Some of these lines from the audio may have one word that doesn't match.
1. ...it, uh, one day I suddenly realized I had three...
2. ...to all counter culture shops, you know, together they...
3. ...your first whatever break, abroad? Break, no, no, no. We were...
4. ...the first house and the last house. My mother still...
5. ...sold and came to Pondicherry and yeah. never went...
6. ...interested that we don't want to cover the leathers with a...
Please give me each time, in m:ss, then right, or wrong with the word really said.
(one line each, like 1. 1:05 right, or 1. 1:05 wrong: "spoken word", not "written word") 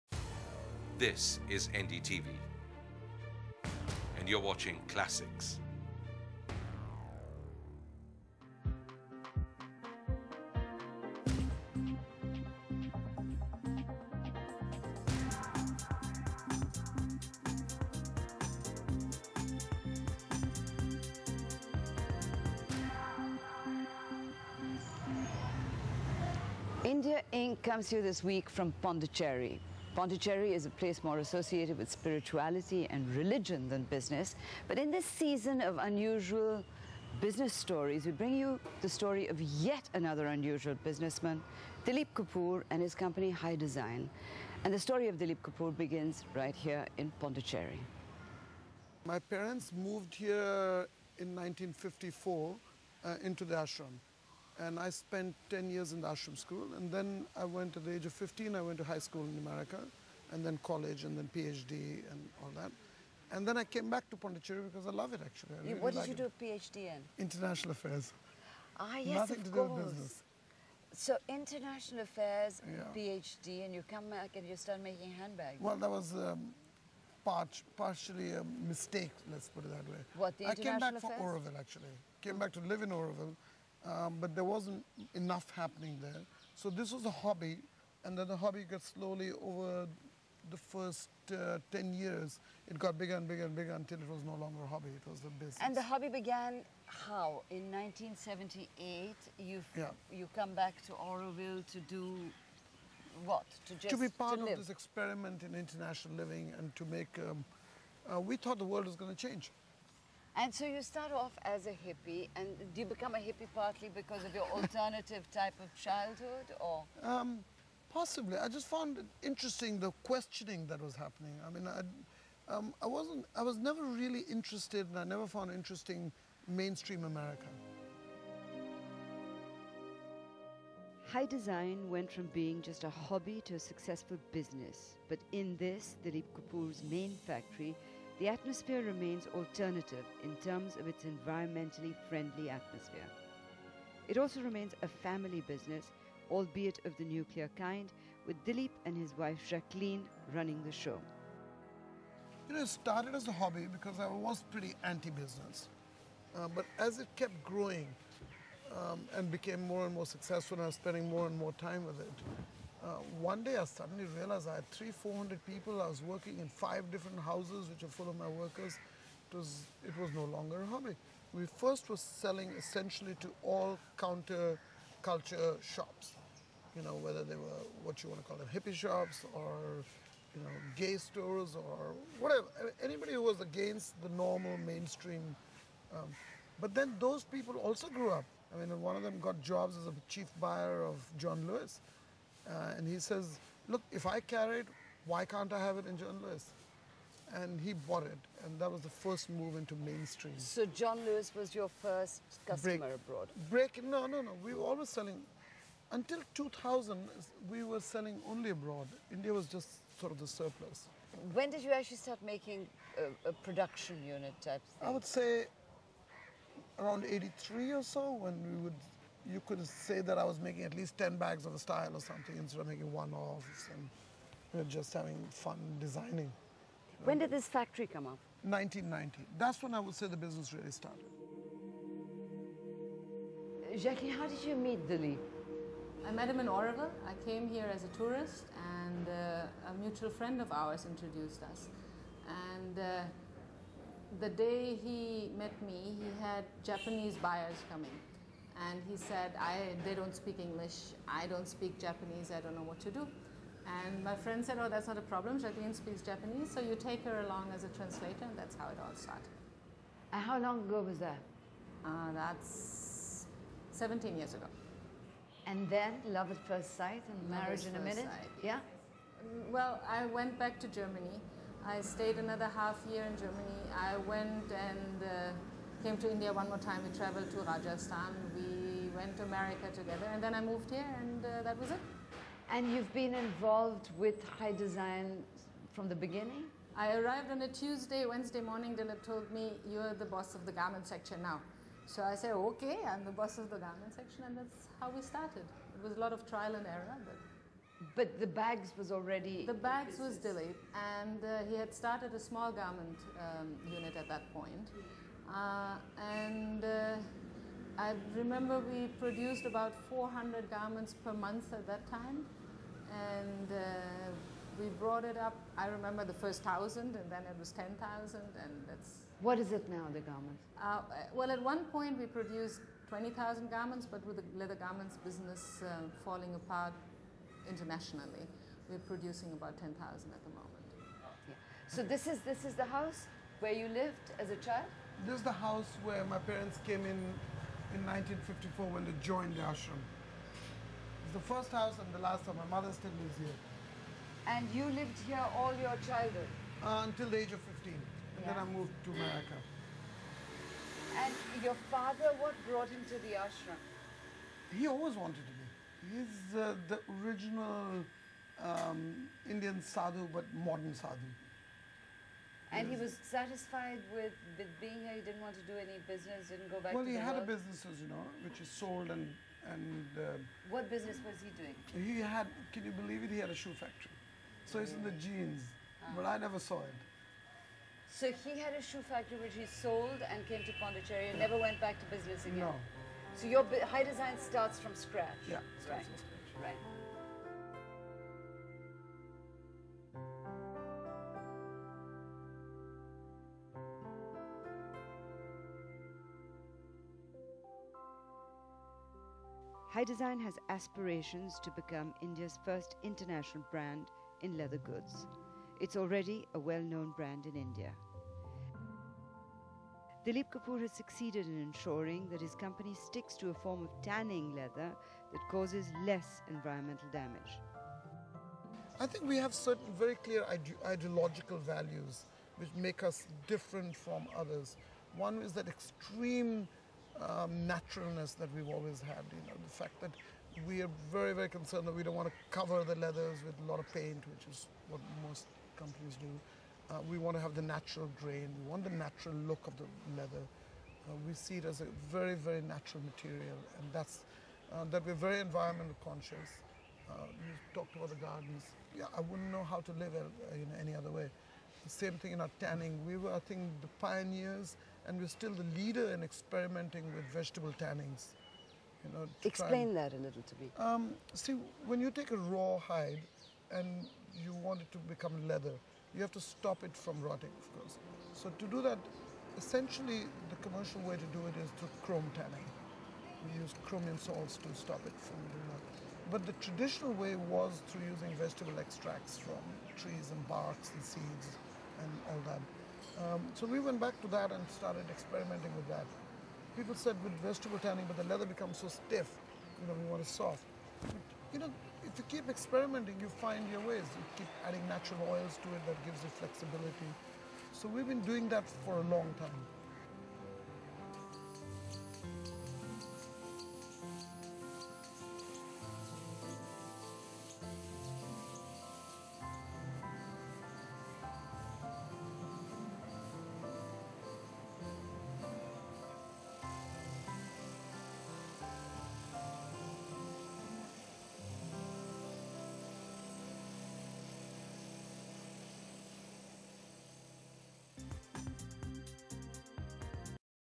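1. 2:41 right
2. 2:53 wrong: "whether", not "together"
3. 3:21 wrong: "customer", not "whatever"
4. 5:41 right
5. 6:19 right
6. 7:11 wrong: "concerned", not "interested".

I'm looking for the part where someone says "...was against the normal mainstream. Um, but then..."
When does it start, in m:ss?
3:03.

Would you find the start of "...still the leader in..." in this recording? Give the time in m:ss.
7:35.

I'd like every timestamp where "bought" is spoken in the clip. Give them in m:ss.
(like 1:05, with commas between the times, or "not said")
3:17.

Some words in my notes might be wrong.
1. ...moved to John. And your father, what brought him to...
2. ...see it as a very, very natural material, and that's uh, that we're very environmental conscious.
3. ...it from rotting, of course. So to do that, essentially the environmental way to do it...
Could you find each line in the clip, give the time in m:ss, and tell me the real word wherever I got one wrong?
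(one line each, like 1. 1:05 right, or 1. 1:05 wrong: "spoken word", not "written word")
1. 5:48 wrong: "America", not "John"
2. 7:21 right
3. 7:46 wrong: "commercial", not "environmental".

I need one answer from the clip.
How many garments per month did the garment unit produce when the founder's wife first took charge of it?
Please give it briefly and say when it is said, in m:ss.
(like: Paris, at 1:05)
400, at 5:09.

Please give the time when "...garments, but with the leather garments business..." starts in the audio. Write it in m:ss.
5:23.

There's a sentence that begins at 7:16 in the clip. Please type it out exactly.
Uh, we want to have the natural grain.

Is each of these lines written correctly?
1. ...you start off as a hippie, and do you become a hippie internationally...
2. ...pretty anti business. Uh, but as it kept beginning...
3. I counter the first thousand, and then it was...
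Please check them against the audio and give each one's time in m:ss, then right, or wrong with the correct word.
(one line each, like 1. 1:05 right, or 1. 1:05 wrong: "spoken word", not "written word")
1. 1:50 wrong: "partly", not "internationally"
2. 2:34 wrong: "growing", not "beginning"
3. 5:15 wrong: "remember", not "counter".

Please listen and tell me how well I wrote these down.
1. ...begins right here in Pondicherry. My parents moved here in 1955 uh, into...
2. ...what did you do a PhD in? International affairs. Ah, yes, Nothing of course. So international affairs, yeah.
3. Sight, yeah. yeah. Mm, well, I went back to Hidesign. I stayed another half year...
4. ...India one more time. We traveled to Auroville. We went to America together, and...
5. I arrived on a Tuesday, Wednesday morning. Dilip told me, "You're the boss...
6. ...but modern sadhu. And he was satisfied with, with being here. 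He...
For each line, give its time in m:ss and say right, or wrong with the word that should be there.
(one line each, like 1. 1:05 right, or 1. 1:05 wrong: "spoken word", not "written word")
1. 0:45 wrong: "1954", not "1955"
2. 1:05 right
3. 4:28 wrong: "Germany", not "Hidesign"
4. 4:36 wrong: "Rajasthan", not "Auroville"
5. 4:46 right
6. 6:00 right.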